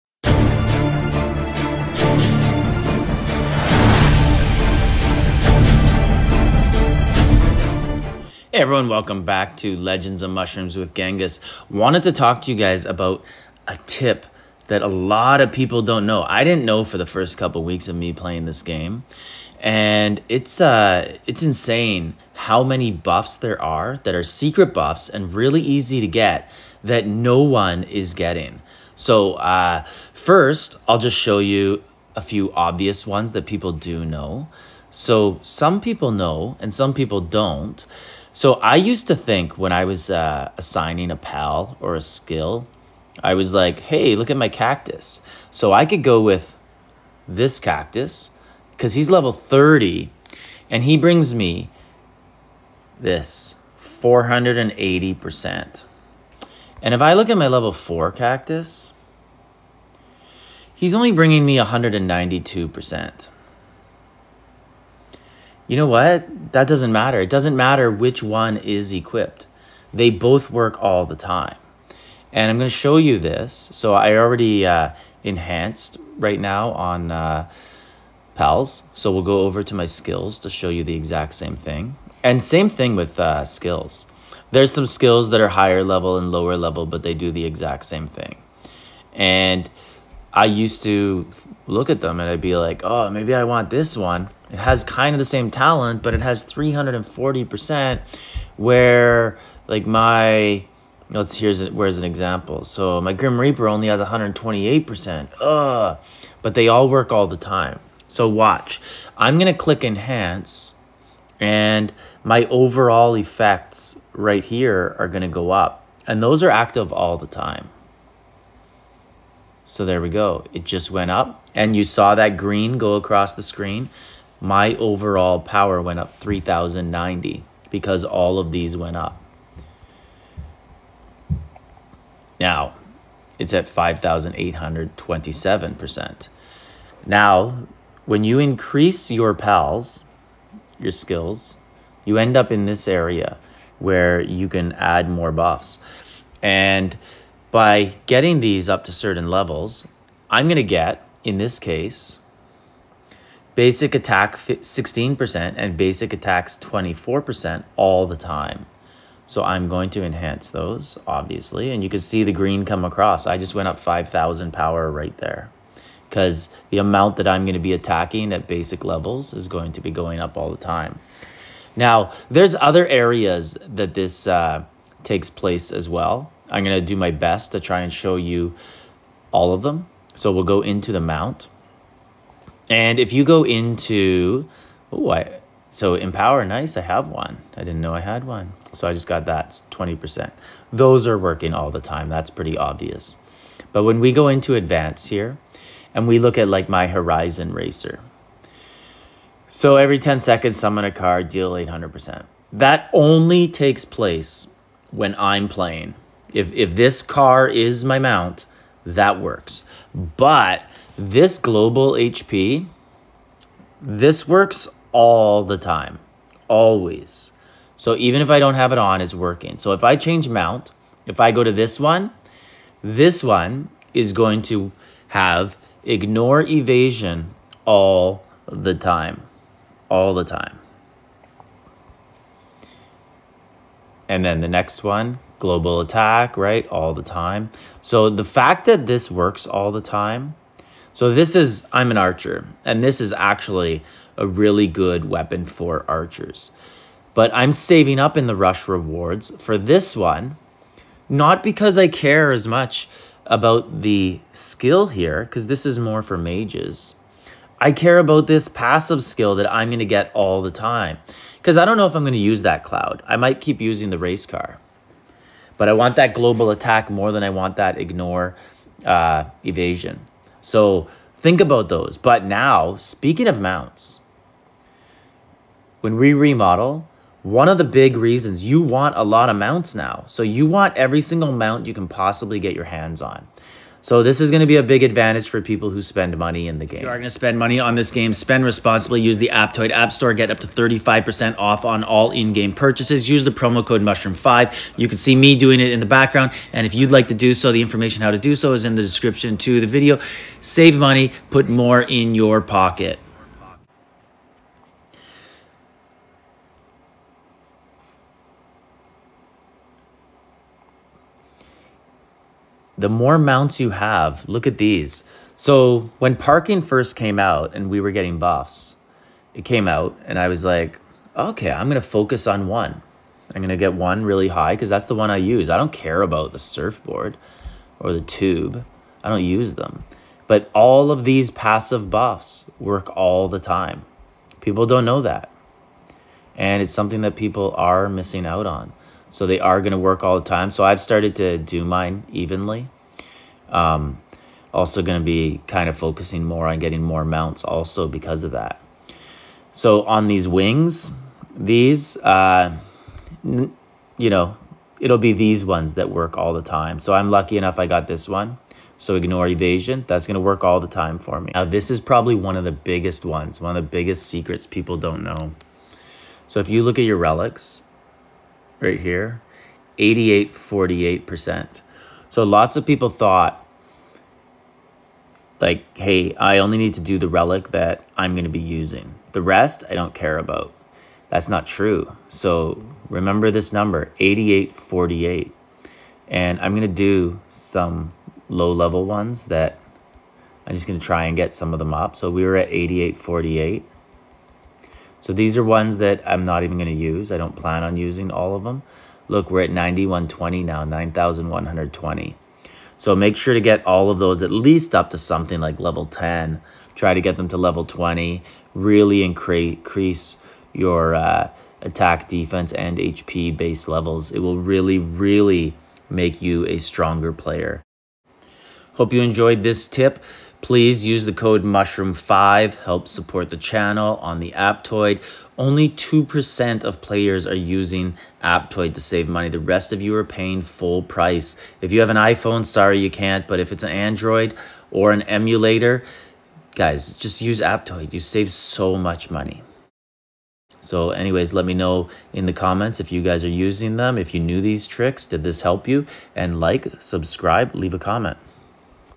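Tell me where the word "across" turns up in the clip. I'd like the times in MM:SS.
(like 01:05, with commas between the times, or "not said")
02:02, 02:42.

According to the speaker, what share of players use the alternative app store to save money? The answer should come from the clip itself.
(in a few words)
2%.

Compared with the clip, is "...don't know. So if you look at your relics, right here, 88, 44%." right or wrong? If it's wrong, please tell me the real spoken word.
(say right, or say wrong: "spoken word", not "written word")
wrong: "48", not "44".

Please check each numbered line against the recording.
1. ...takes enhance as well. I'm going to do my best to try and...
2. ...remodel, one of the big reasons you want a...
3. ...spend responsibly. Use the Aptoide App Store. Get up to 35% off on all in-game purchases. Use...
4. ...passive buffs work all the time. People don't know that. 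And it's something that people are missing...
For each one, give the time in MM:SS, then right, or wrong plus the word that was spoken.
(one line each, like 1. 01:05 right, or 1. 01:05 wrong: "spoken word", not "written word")
1. 02:55 wrong: "place", not "enhance"
2. 04:36 right
3. 04:48 right
4. 05:31 right.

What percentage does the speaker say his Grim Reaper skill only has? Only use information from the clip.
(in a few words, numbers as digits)
128%.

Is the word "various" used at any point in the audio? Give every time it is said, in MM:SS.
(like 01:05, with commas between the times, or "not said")
not said.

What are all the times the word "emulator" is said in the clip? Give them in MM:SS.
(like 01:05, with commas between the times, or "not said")
07:15.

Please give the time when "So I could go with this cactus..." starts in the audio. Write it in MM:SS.
00:45.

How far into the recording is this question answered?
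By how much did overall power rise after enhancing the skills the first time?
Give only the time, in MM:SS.
02:06.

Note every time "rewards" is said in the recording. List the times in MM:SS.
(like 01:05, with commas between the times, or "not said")
04:08.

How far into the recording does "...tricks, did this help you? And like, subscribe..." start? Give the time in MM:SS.
07:24.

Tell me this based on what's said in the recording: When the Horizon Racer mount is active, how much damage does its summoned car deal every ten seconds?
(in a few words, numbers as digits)
800%.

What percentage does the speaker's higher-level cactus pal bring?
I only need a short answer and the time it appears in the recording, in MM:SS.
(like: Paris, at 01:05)
480%, at 00:53.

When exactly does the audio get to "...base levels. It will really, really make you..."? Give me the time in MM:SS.
06:53.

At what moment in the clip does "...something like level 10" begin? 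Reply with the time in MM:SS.
06:44.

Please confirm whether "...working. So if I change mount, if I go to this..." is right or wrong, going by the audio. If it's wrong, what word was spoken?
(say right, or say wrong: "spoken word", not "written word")
right.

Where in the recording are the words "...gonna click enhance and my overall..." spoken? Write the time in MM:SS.
01:49.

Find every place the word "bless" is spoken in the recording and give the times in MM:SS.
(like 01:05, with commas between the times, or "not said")
not said.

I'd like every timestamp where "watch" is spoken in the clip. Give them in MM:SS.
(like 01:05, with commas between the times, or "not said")
01:48.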